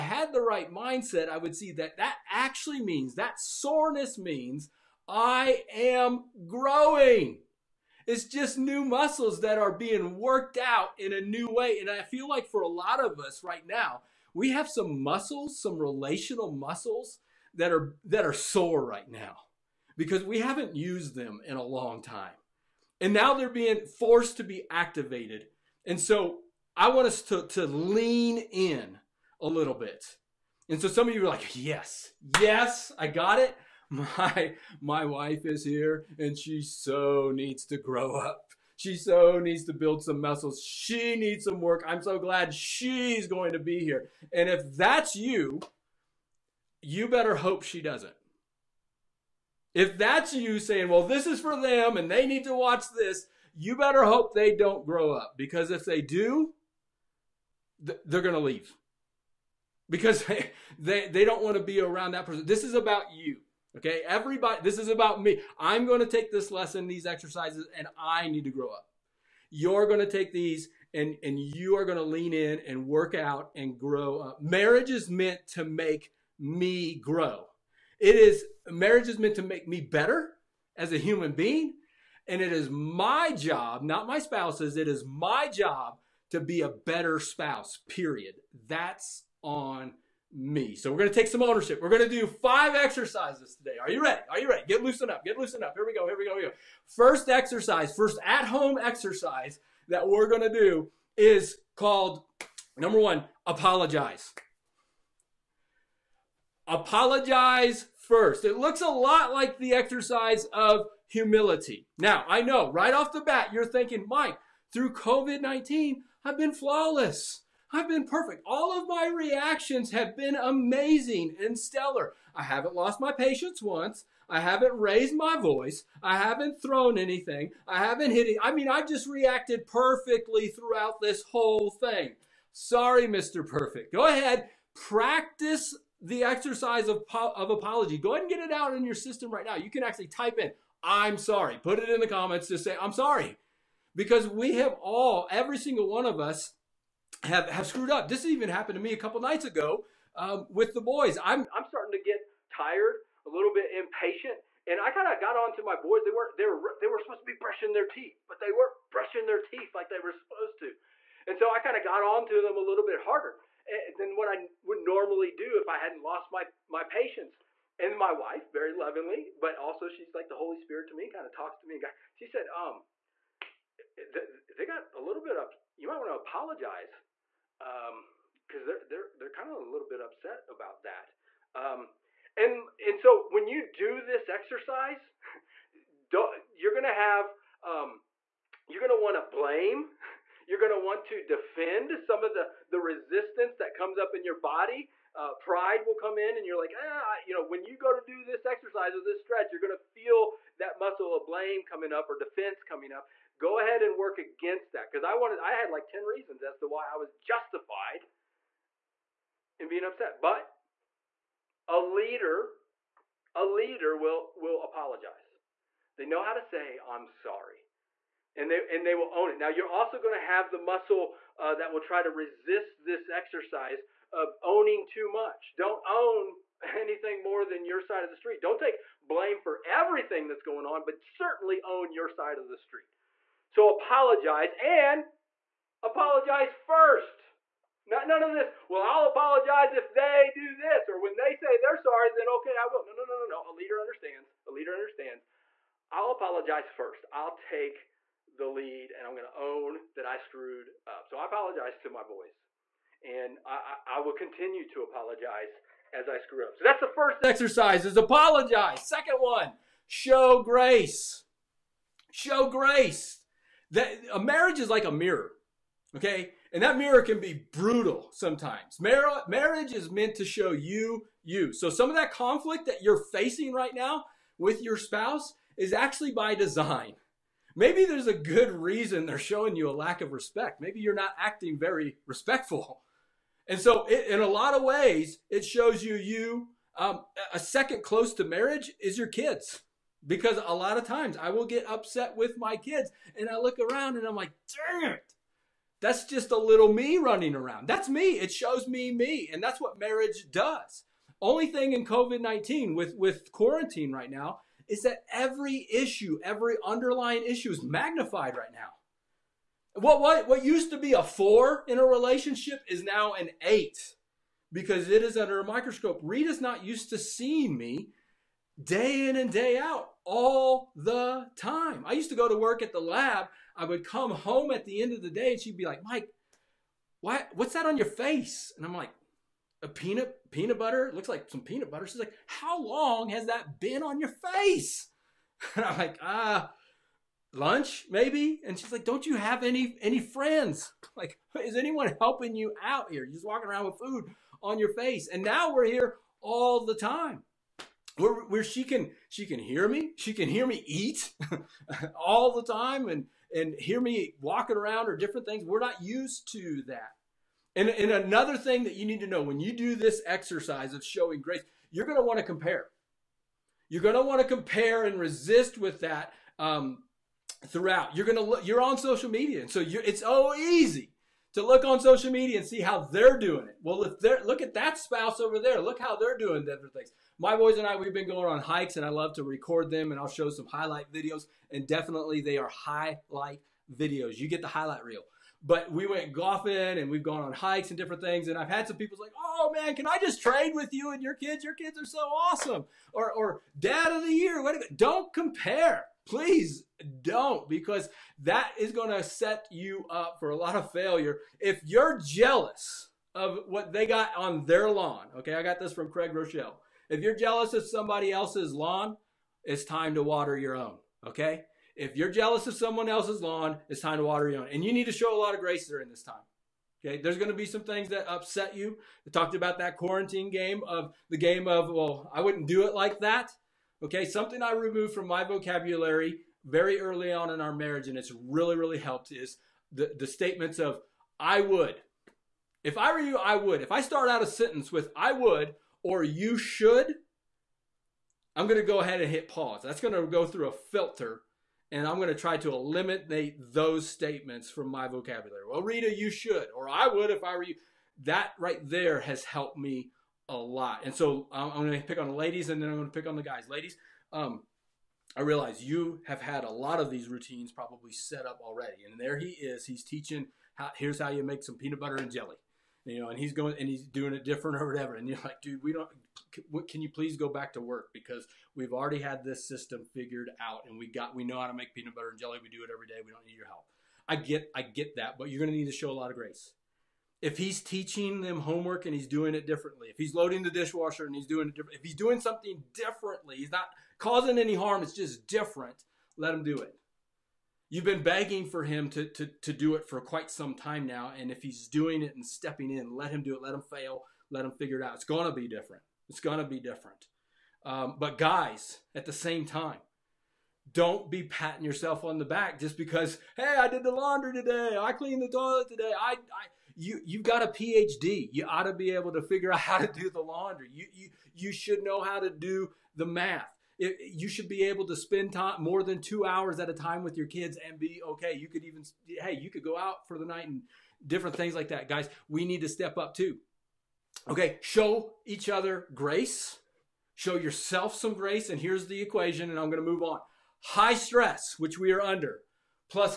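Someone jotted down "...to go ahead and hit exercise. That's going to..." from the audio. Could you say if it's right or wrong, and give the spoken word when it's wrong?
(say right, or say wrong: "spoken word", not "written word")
wrong: "pause", not "exercise".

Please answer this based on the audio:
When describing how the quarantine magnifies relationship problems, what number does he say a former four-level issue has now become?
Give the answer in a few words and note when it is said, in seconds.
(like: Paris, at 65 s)
8, at 313 s.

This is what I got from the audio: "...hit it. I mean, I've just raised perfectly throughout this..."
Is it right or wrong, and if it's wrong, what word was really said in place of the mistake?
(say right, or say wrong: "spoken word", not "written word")
wrong: "reacted", not "raised".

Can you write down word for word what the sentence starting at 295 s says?
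That's just a little me running around.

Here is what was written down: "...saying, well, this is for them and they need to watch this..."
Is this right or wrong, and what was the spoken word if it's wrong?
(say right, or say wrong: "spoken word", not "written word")
right.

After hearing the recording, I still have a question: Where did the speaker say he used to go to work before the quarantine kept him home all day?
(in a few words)
the lab.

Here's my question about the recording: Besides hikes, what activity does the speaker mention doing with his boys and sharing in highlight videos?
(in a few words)
golfing.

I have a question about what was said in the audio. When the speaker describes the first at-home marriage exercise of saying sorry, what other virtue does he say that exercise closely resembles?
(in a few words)
humility.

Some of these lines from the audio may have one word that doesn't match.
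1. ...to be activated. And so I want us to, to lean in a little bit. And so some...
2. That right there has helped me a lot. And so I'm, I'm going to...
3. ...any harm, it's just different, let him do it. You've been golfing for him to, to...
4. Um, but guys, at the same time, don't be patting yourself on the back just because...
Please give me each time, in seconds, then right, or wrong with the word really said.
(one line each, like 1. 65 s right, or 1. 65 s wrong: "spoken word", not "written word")
1. 24 s right
2. 448 s right
3. 484 s wrong: "begging", not "golfing"
4. 497 s right.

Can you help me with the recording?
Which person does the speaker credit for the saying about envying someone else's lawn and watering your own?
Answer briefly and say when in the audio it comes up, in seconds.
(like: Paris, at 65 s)
Craig Groeschel, at 405 s.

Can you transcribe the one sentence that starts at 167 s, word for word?
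And my wife, very lovingly, but also she's like the Holy Spirit to me, kind of talks to me.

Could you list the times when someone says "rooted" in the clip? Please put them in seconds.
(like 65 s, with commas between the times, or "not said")
not said.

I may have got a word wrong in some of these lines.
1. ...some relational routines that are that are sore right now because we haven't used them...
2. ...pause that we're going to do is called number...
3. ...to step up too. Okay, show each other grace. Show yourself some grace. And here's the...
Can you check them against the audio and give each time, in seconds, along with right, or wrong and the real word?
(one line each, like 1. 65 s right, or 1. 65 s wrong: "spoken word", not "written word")
1. 15 s wrong: "muscles", not "routines"
2. 98 s wrong: "exercise", not "pause"
3. 522 s right.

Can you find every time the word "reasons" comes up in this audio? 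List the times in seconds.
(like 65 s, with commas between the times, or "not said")
206 s, 278 s.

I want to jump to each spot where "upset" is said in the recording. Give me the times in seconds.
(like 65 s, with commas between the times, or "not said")
180 s, 209 s, 291 s, 418 s.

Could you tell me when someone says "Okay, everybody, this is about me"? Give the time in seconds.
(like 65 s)
63 s.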